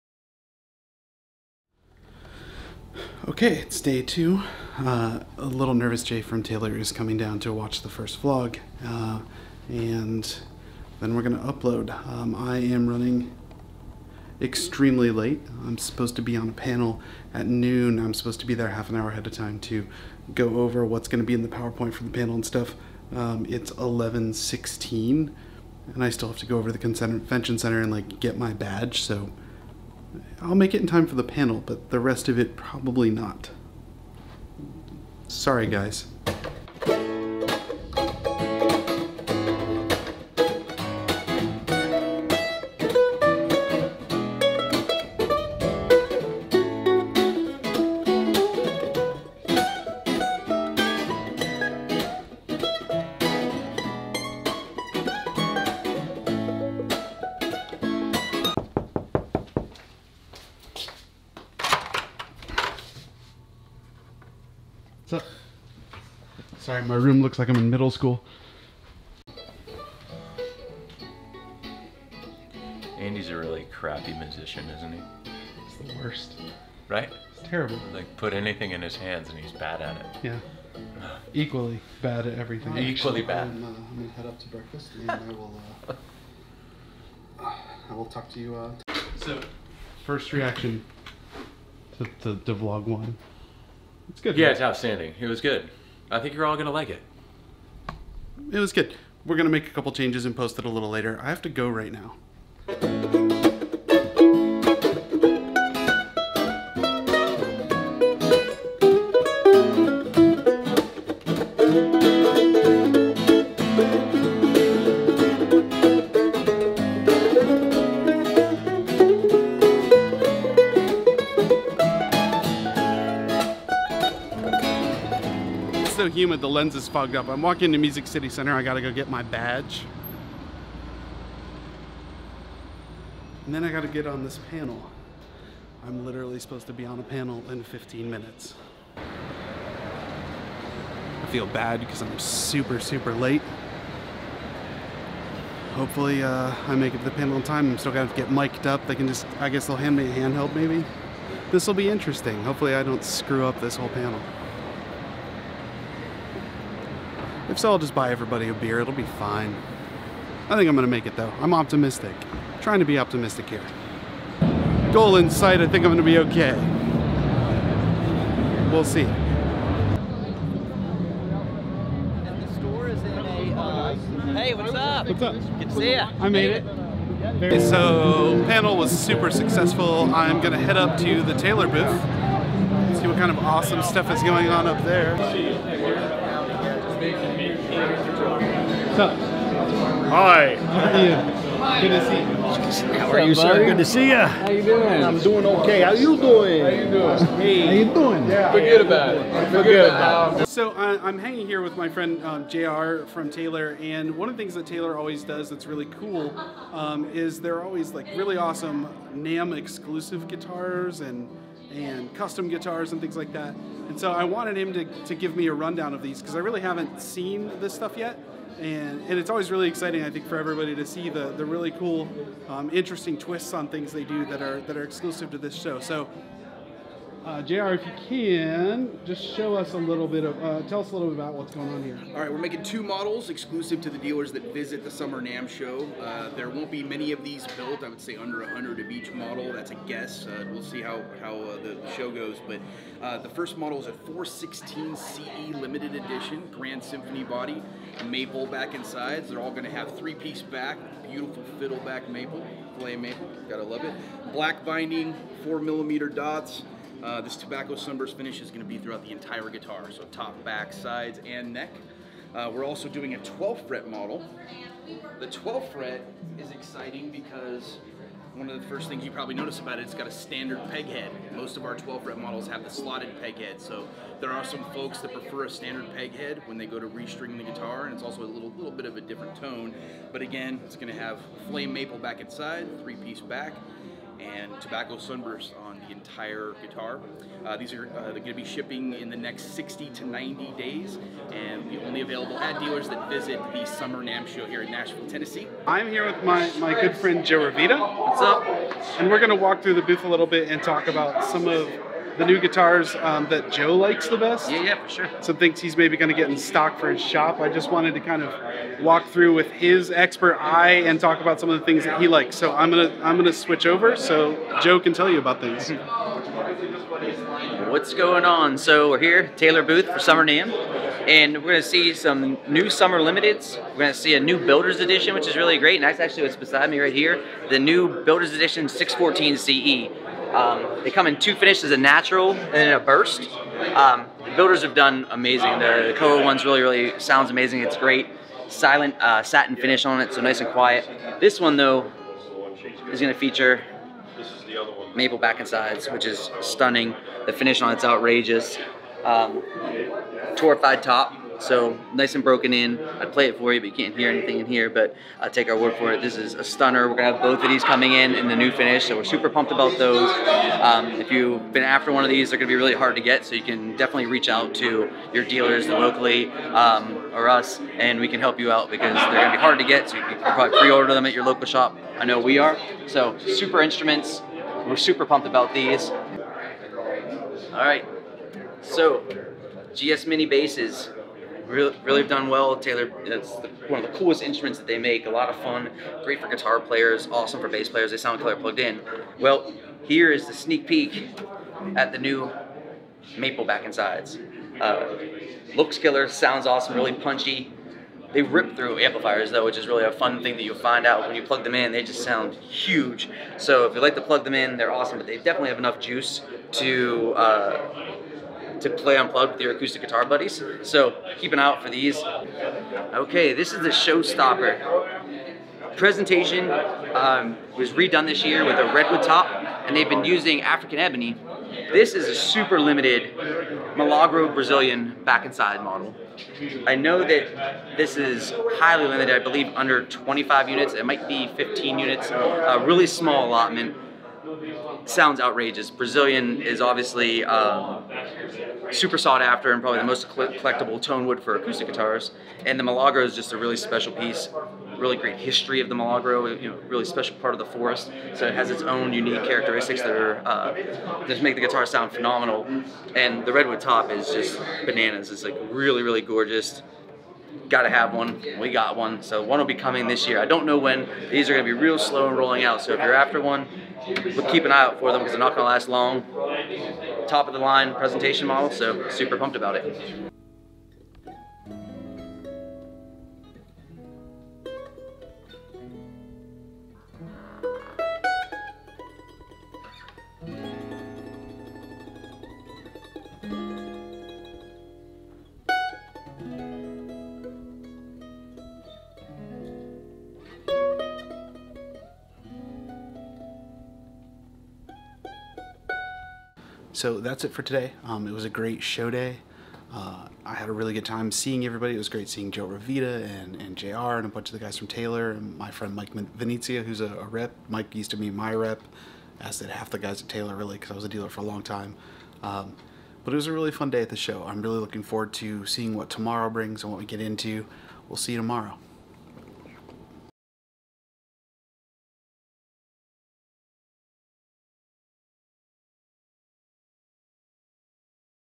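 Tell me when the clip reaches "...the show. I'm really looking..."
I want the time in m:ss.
8:33.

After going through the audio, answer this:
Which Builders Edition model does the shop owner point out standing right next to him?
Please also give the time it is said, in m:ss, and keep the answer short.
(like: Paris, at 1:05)
614 CE, at 5:28.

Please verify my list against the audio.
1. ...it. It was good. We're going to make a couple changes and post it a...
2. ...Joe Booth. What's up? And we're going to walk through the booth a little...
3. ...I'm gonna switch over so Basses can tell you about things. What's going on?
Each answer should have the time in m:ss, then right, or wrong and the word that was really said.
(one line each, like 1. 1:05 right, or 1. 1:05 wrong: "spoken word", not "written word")
1. 1:36 right
2. 4:57 wrong: "Ravita", not "Booth"
3. 5:13 wrong: "Joe", not "Basses".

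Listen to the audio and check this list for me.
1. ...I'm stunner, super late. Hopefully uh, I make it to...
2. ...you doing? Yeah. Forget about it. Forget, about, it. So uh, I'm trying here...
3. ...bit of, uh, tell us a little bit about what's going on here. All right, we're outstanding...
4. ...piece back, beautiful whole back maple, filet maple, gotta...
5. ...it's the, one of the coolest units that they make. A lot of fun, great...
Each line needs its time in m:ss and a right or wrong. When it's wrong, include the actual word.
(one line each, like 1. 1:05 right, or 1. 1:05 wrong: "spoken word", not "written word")
1. 2:22 wrong: "super", not "stunner"
2. 3:17 wrong: "hanging", not "trying"
3. 3:50 wrong: "making", not "outstanding"
4. 4:10 wrong: "fiddle", not "whole"
5. 6:23 wrong: "instruments", not "units".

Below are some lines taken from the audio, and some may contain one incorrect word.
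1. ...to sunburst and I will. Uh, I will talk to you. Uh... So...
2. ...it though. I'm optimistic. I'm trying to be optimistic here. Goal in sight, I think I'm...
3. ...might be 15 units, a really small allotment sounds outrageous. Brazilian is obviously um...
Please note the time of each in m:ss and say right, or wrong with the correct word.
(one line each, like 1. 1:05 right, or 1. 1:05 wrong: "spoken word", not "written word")
1. 1:24 wrong: "breakfast", not "sunburst"
2. 2:41 right
3. 7:10 right.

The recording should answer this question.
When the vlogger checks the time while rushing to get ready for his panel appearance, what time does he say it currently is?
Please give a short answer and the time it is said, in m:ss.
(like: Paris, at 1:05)
11:16, at 0:23.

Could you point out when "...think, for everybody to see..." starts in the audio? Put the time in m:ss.
3:40.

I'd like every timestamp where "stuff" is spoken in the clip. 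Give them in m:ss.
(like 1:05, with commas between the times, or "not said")
0:22, 3:03, 3:37.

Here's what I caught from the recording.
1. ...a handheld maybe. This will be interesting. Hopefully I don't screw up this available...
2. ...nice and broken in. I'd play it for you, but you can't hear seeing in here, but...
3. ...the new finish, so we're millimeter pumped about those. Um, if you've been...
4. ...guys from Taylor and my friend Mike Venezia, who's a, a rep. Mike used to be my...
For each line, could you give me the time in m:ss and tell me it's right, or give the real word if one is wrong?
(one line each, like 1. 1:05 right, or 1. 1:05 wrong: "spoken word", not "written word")
1. 2:30 wrong: "whole", not "available"
2. 5:51 wrong: "anything", not "seeing"
3. 5:58 wrong: "super", not "millimeter"
4. 8:24 right.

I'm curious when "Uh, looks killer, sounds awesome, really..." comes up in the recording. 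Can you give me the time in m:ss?
6:34.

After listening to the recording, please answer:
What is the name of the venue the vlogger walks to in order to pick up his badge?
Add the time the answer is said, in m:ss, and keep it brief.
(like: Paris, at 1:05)
Music City Center, at 2:07.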